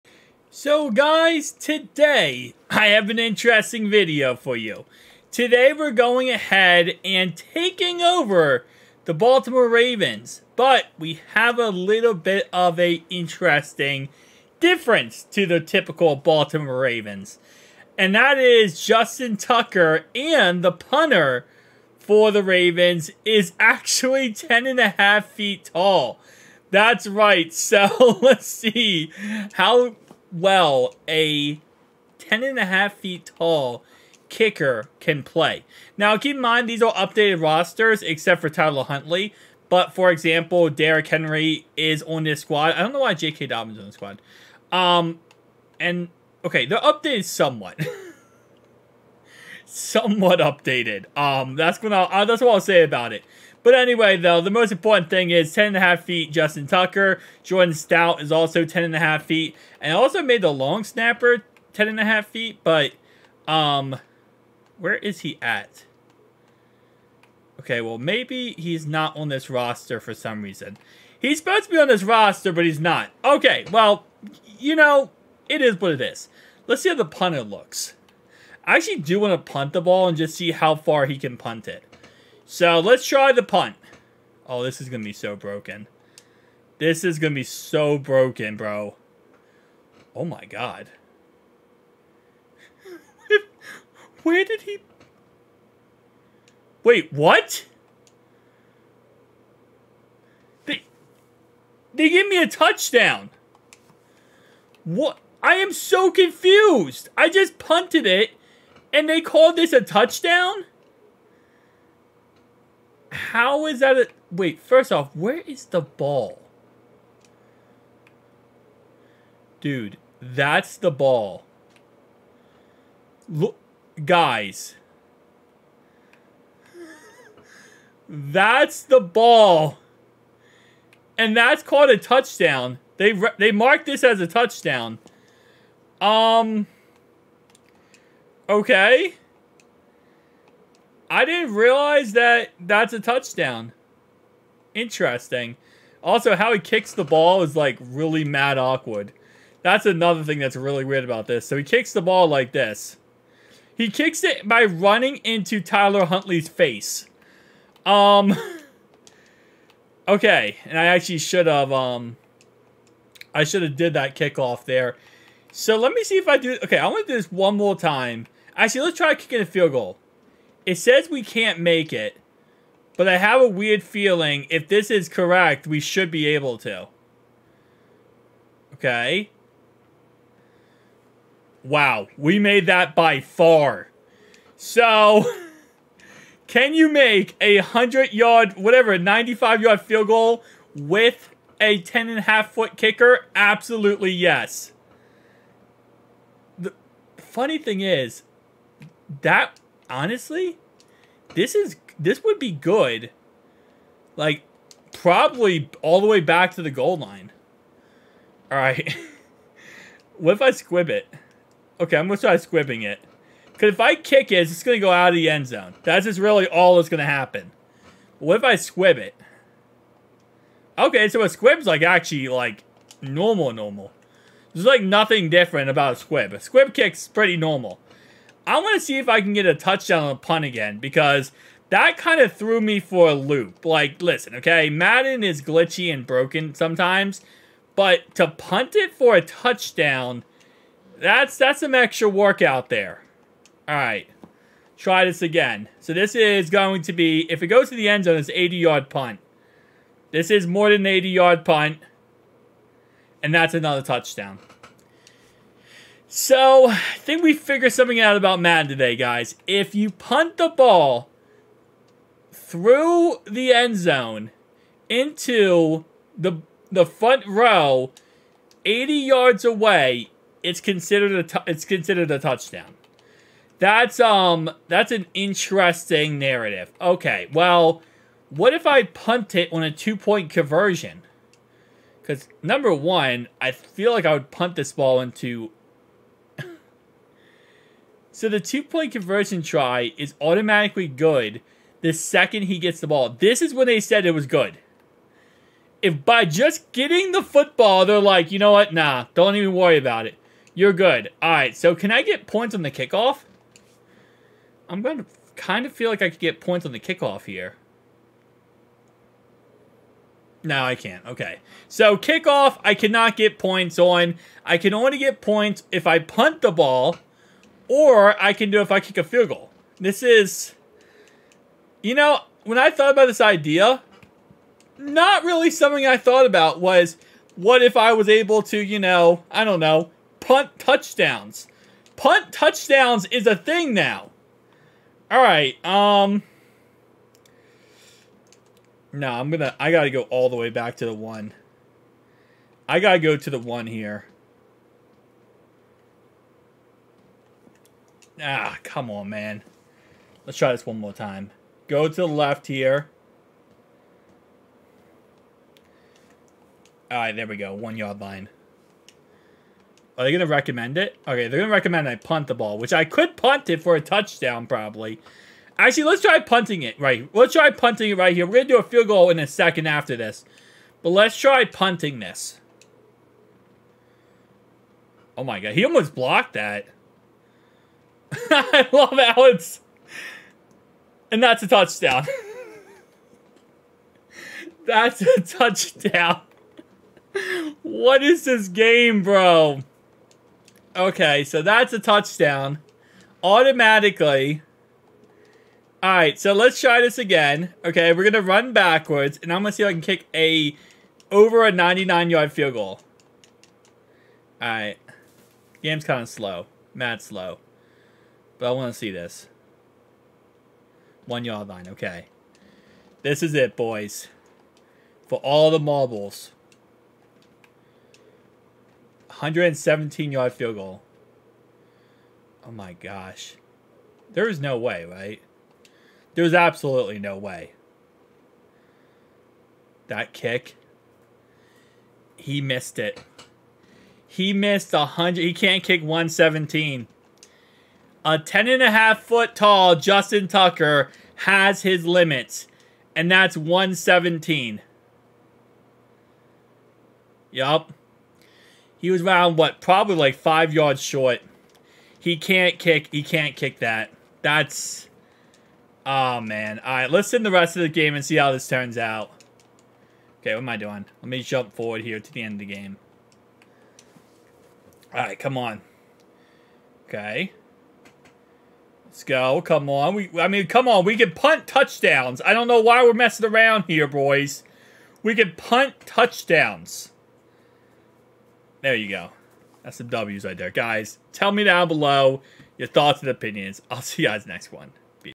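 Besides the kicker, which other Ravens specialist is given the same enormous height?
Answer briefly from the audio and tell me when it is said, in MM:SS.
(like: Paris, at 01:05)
Jordan Stout, at 00:57.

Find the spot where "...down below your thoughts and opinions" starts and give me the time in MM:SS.
08:01.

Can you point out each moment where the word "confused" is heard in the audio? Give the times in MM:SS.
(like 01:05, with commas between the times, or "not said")
01:46.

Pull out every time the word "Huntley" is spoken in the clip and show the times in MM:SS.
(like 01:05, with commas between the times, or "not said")
00:38, 02:36.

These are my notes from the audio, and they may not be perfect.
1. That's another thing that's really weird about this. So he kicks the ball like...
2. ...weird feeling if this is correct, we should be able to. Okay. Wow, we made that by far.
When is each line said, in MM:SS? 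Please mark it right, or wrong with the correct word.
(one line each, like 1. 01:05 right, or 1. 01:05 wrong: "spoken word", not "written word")
1. 02:29 right
2. 02:53 right.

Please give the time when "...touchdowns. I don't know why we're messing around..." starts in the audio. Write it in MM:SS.
07:51.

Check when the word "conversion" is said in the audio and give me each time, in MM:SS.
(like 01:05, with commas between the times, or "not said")
04:40, 04:48.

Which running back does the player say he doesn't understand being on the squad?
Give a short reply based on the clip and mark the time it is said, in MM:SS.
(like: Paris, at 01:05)
J.K. Dobbins, at 00:43.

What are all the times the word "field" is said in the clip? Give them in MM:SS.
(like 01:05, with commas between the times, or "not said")
02:49, 03:09, 05:19, 06:08, 06:42, 07:00.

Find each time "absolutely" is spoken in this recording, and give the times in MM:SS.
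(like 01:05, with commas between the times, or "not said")
03:13, 07:06.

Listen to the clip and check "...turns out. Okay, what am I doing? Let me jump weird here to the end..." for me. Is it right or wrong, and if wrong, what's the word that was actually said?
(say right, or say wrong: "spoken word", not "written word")
wrong: "forward", not "weird".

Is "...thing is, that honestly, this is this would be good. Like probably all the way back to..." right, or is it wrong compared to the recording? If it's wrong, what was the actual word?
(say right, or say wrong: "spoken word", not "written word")
right.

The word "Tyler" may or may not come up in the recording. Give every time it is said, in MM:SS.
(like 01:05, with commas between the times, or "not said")
00:38, 02:35.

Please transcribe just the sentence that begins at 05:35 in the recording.
All right, um No, I'm going to I got to go all the way back to the 1.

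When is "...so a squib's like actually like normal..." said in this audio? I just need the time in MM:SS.
03:41.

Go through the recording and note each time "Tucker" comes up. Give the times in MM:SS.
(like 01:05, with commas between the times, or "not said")
00:19, 00:56, 07:20.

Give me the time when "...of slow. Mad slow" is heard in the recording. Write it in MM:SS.
06:46.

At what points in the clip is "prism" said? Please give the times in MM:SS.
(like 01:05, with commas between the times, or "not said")
not said.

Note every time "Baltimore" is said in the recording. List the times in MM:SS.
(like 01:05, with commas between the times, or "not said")
00:09, 00:16.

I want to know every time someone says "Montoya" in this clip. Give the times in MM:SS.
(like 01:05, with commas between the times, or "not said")
not said.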